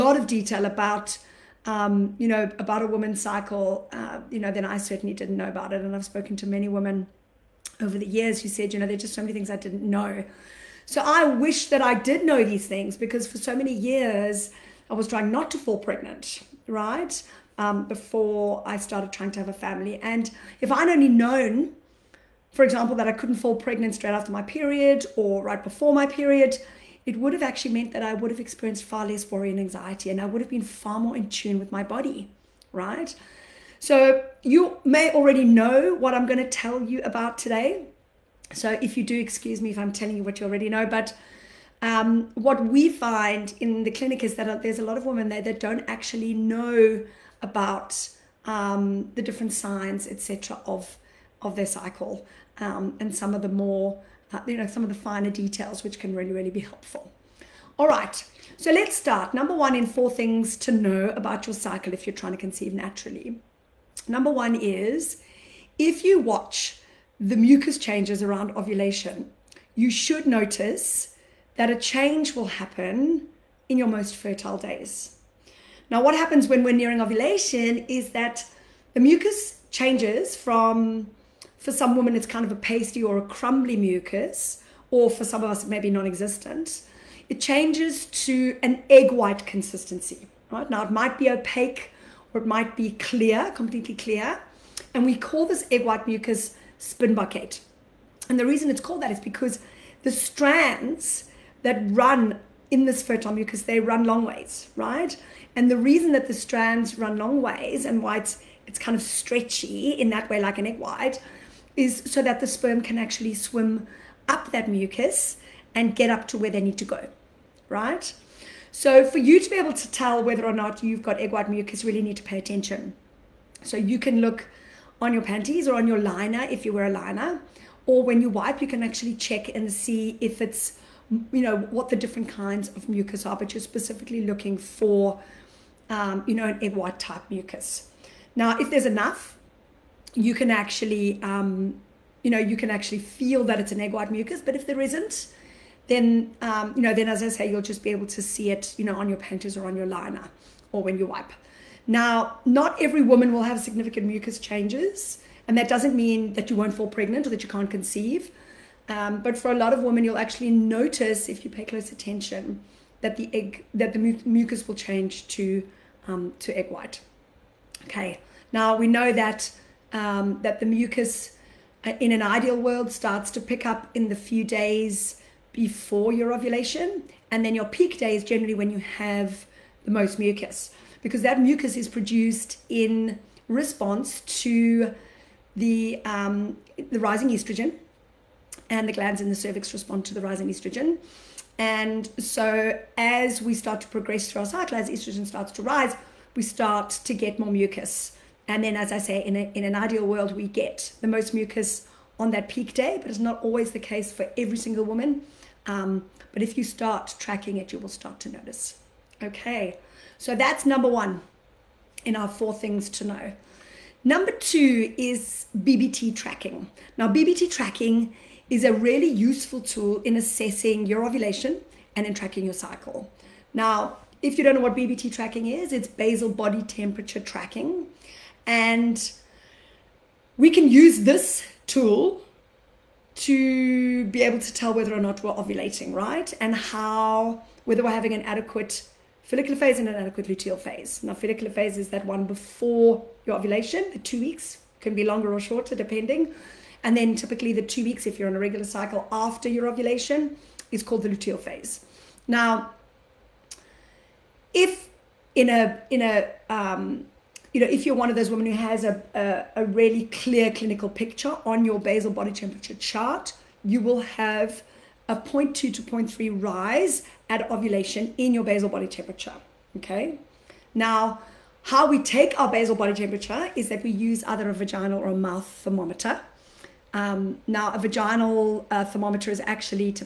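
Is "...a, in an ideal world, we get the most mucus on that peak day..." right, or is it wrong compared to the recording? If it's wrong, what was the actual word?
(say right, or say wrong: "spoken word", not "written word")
right.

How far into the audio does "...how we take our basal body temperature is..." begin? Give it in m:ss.
4:31.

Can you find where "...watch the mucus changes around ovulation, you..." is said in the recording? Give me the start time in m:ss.
1:06.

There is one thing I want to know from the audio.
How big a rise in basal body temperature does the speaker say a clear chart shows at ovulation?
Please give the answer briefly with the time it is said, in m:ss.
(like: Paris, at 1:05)
0.2 to 0.3, at 4:25.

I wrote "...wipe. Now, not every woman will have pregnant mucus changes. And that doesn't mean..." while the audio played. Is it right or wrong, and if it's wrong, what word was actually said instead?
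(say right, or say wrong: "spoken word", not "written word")
wrong: "significant", not "pregnant".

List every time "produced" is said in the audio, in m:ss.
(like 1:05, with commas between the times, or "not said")
3:01.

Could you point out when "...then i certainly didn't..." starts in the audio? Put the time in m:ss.
0:04.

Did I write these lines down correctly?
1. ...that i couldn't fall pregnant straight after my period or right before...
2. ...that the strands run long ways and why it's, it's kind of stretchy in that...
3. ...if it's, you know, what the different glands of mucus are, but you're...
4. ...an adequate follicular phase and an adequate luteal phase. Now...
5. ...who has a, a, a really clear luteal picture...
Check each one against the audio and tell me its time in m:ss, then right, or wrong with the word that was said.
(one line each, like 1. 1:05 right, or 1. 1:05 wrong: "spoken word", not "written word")
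1. 0:22 right
2. 1:46 right
3. 2:10 wrong: "kinds", not "glands"
4. 3:58 right
5. 4:18 wrong: "clinical", not "luteal".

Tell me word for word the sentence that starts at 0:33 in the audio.
So you may already know what I'm going to tell you about today.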